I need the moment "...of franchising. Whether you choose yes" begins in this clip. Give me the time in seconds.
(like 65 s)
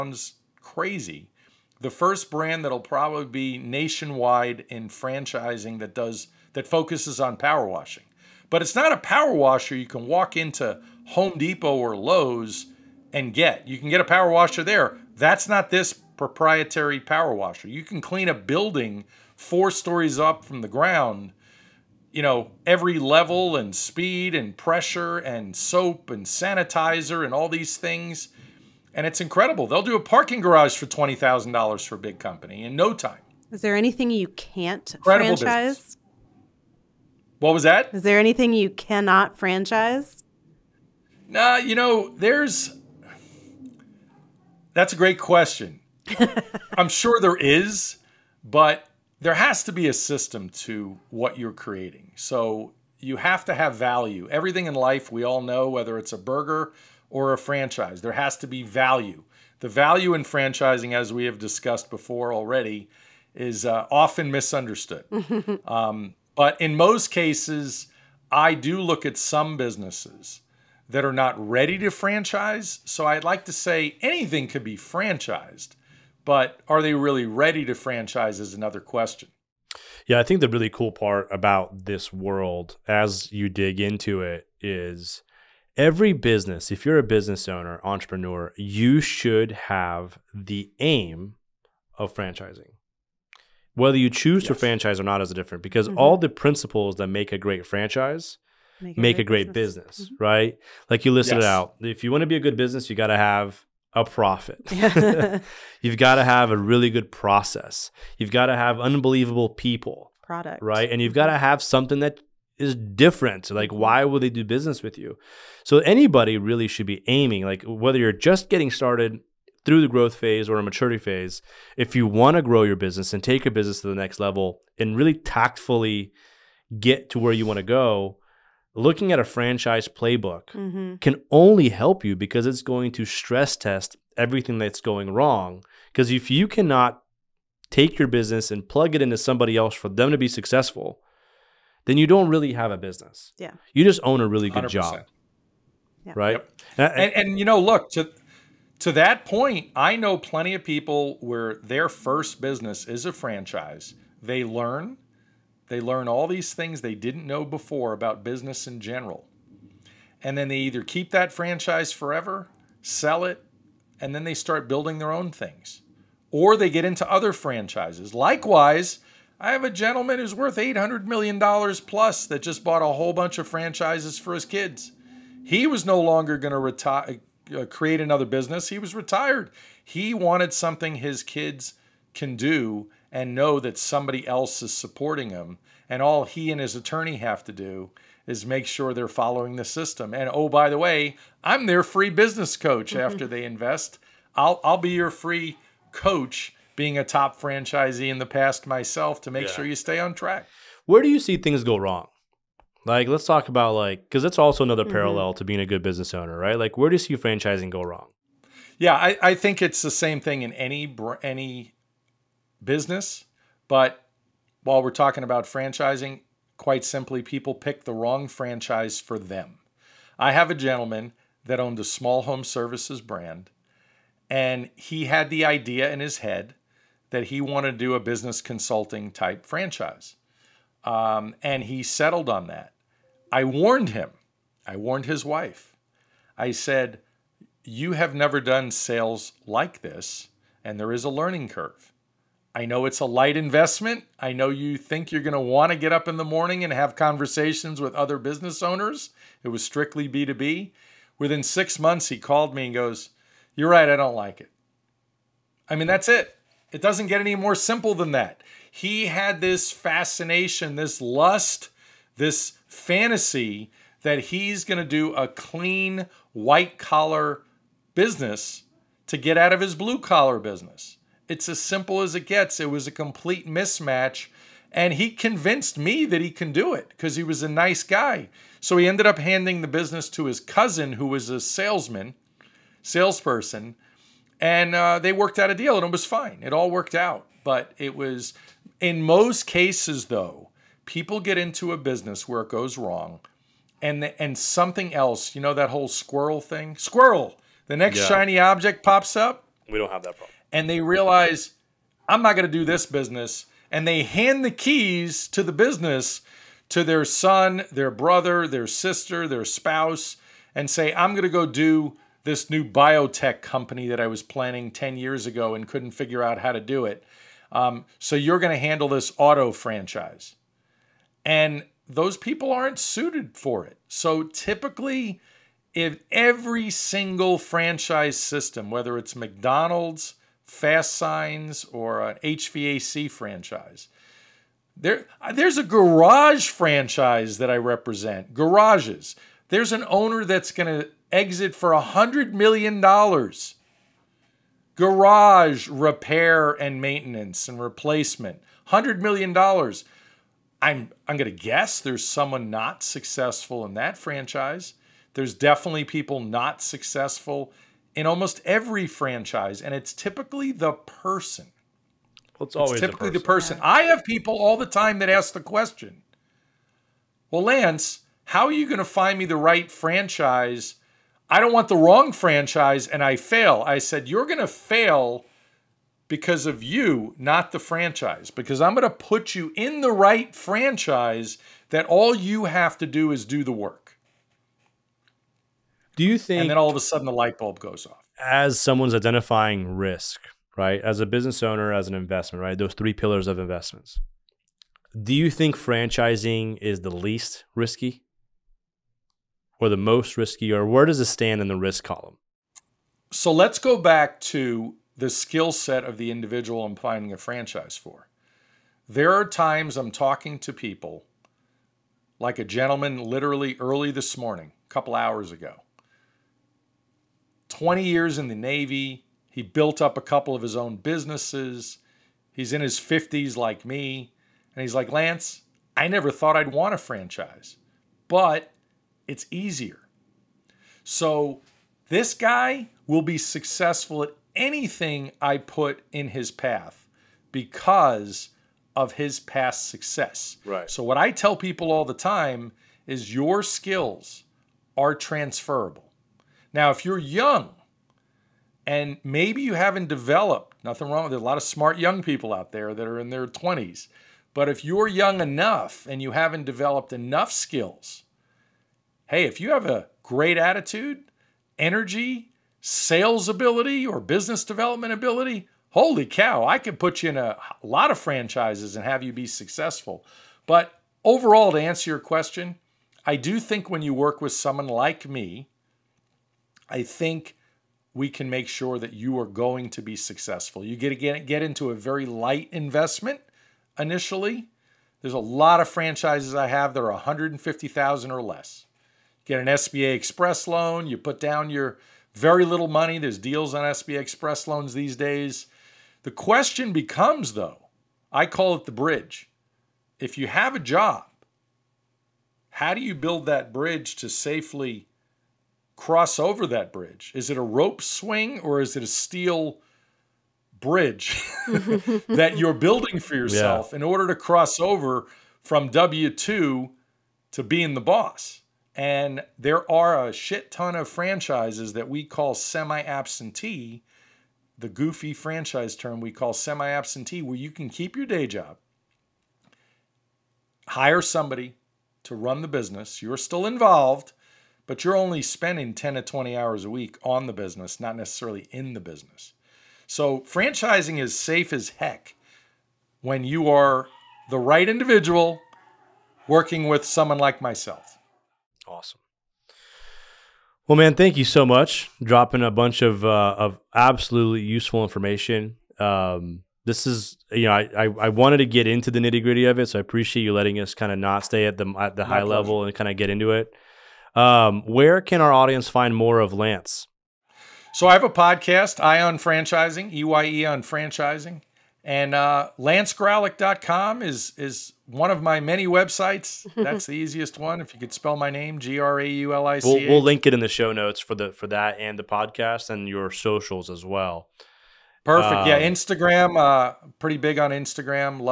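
91 s.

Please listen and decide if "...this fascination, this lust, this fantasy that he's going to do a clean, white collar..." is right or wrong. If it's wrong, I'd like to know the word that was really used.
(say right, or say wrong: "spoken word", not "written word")
right.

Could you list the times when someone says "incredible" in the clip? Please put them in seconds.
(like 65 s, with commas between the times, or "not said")
29 s, 34 s.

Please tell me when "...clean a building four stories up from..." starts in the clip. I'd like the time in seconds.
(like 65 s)
17 s.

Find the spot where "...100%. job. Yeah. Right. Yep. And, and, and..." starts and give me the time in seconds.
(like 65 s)
144 s.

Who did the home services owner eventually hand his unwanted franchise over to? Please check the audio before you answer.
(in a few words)
His cousin.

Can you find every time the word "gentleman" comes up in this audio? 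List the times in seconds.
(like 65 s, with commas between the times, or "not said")
169 s, 220 s, 412 s.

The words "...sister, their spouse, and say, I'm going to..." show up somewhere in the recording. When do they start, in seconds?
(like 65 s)
308 s.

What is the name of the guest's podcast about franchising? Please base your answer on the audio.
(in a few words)
EYE on Franchising.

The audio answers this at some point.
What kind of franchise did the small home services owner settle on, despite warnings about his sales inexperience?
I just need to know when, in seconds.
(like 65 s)
227 s.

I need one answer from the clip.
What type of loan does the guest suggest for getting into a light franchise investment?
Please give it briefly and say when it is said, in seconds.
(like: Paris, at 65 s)
SBA Express loan, at 489 s.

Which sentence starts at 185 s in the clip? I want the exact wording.
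And all he and his attorney have to do is make sure they're following the system.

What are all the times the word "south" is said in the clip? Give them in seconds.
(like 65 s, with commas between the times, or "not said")
not said.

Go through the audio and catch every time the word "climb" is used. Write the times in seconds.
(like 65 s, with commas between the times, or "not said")
not said.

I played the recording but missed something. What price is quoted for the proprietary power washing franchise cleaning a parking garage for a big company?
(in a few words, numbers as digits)
$20,000.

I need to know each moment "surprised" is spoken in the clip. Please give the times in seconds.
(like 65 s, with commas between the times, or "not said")
not said.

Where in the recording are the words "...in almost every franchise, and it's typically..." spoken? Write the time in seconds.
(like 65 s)
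357 s.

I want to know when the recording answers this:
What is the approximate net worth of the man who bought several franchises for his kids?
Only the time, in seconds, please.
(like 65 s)
170 s.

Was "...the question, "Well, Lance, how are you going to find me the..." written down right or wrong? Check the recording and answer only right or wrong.
right.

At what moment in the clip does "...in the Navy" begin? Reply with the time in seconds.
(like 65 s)
418 s.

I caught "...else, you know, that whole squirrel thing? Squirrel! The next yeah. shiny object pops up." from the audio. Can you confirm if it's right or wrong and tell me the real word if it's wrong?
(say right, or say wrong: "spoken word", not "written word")
right.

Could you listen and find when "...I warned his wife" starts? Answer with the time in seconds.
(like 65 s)
234 s.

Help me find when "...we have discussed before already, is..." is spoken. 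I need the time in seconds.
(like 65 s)
61 s.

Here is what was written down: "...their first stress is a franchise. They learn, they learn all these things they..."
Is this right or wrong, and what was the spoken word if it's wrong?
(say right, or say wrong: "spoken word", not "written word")
wrong: "business", not "stress".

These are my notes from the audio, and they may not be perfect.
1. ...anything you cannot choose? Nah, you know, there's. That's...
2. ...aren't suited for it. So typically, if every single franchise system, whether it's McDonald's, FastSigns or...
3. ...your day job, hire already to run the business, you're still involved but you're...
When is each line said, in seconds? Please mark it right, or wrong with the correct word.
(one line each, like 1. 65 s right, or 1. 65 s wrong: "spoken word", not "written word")
1. 38 s wrong: "franchise", not "choose"
2. 322 s right
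3. 527 s wrong: "somebody", not "already".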